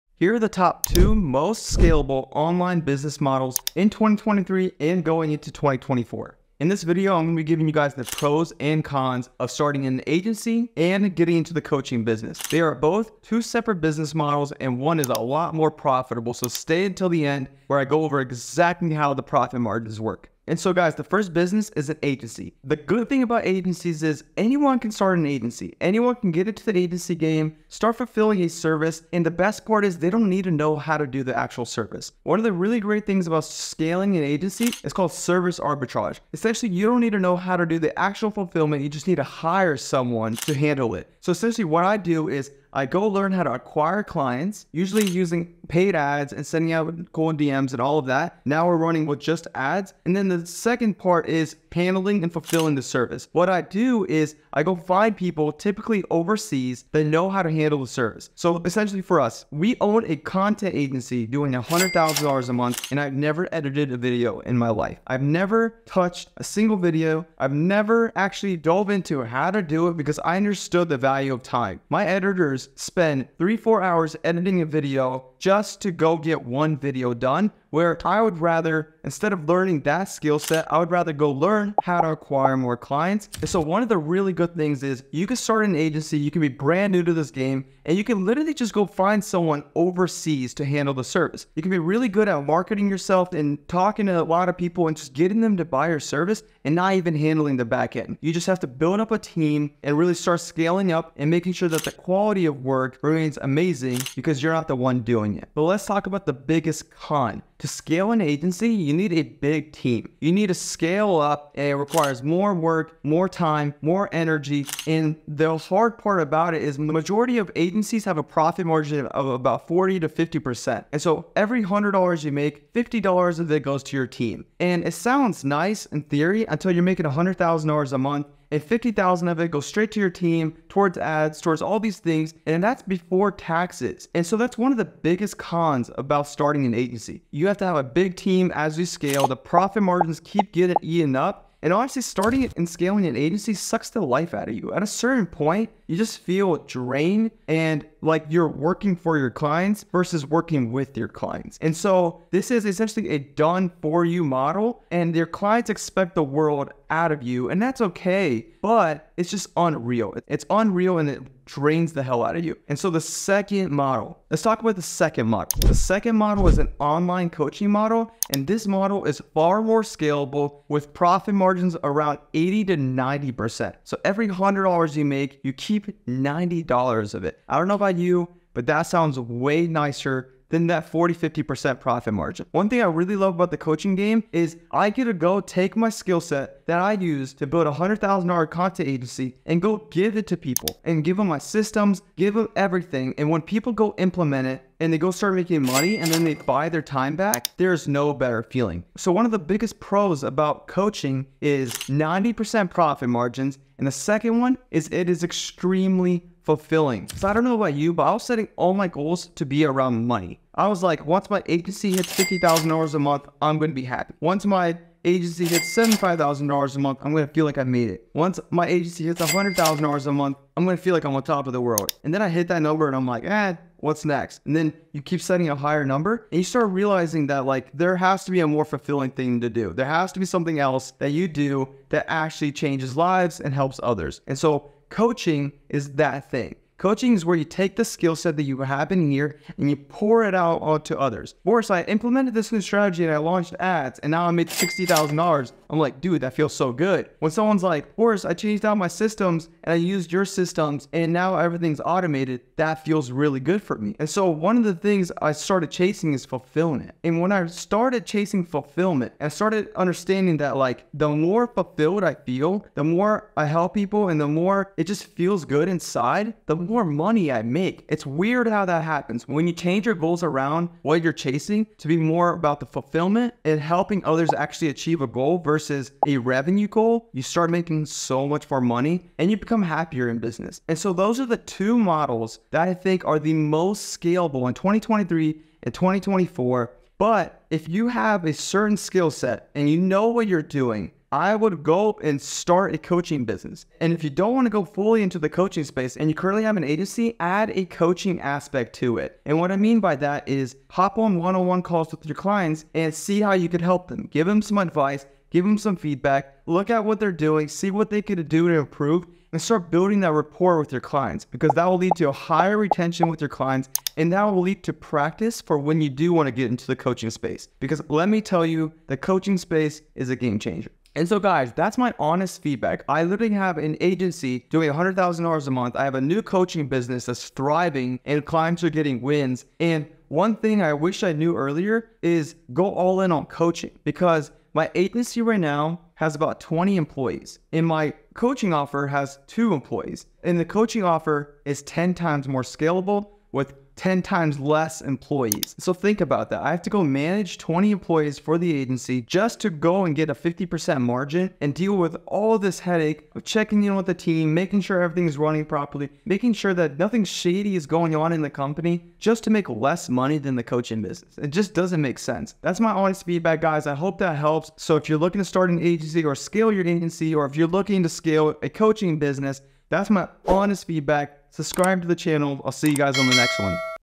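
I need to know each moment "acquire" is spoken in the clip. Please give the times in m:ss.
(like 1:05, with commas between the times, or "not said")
0:43, 1:22.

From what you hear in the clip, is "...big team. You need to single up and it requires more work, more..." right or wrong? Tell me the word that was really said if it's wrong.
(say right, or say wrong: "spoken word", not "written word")
wrong: "scale", not "single".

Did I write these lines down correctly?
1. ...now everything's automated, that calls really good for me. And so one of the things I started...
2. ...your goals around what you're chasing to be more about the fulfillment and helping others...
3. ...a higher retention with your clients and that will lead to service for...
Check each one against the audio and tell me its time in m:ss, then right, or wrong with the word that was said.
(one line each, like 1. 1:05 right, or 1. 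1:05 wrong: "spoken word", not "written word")
1. 4:11 wrong: "feels", not "calls"
2. 4:29 right
3. 5:12 wrong: "practice", not "service".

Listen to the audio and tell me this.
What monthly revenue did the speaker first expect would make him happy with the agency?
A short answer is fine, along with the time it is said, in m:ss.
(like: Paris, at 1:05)
$50,000, at 3:32.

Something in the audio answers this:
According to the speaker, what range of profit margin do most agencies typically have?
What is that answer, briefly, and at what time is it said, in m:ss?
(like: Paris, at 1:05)
40 to 50%, at 1:59.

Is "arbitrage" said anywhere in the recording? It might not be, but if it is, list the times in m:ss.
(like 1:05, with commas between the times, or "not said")
0:35.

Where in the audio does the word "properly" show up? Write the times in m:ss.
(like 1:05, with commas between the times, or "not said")
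5:55.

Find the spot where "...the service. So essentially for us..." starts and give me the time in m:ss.
0:57.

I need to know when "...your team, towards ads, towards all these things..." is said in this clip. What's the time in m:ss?
2:09.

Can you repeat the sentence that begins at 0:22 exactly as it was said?
The good thing about agencies is anyone can start an agency.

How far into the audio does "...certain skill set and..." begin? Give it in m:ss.
4:48.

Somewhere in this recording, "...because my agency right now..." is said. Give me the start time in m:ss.
5:33.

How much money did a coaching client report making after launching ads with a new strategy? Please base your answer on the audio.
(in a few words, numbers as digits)
$60,000.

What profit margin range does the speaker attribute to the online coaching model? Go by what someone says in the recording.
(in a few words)
80 to 90%.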